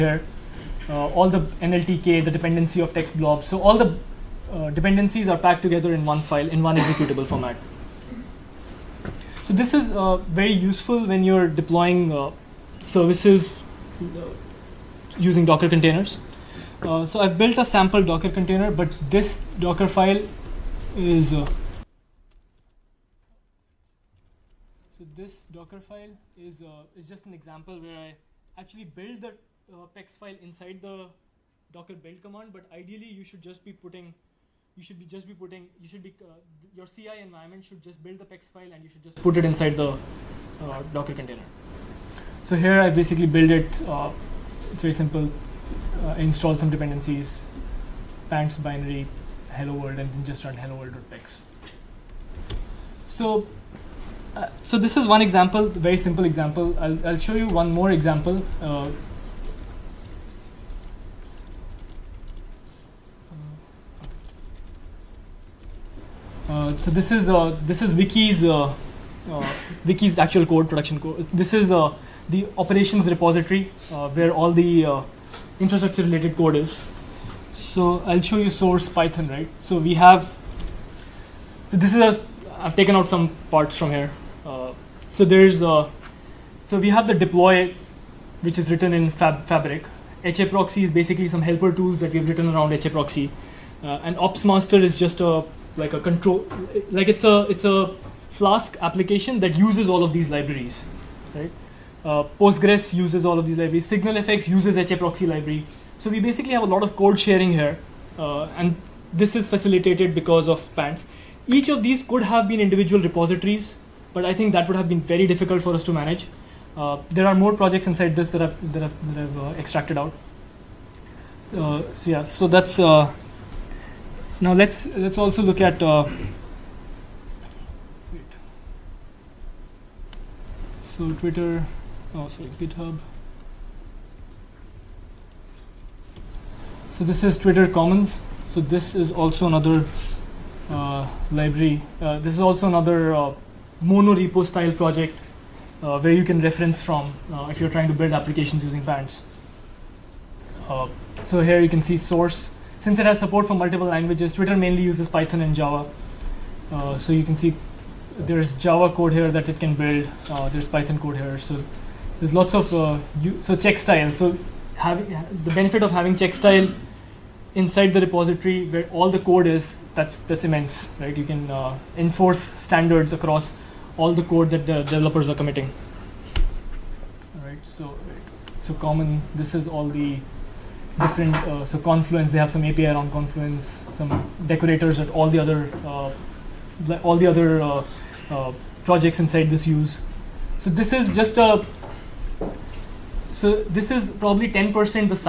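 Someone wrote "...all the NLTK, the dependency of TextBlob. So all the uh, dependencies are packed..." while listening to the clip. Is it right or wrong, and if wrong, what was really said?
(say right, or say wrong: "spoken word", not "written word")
right.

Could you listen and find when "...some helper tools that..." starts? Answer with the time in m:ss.
1:31.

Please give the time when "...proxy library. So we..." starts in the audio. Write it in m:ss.
1:44.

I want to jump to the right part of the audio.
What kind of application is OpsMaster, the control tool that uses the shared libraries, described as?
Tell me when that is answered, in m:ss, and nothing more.
1:38.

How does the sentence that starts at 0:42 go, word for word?
So here I basically build it.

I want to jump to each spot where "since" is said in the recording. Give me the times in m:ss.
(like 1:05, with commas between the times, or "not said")
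2:32.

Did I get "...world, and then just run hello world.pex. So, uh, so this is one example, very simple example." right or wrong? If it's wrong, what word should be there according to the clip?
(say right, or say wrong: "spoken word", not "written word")
right.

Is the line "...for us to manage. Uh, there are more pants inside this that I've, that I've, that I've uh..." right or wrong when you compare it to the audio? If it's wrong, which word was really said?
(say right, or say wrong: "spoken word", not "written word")
wrong: "projects", not "pants".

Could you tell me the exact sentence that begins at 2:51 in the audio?
You can uh, enforce standards across all the code that the developers are committing.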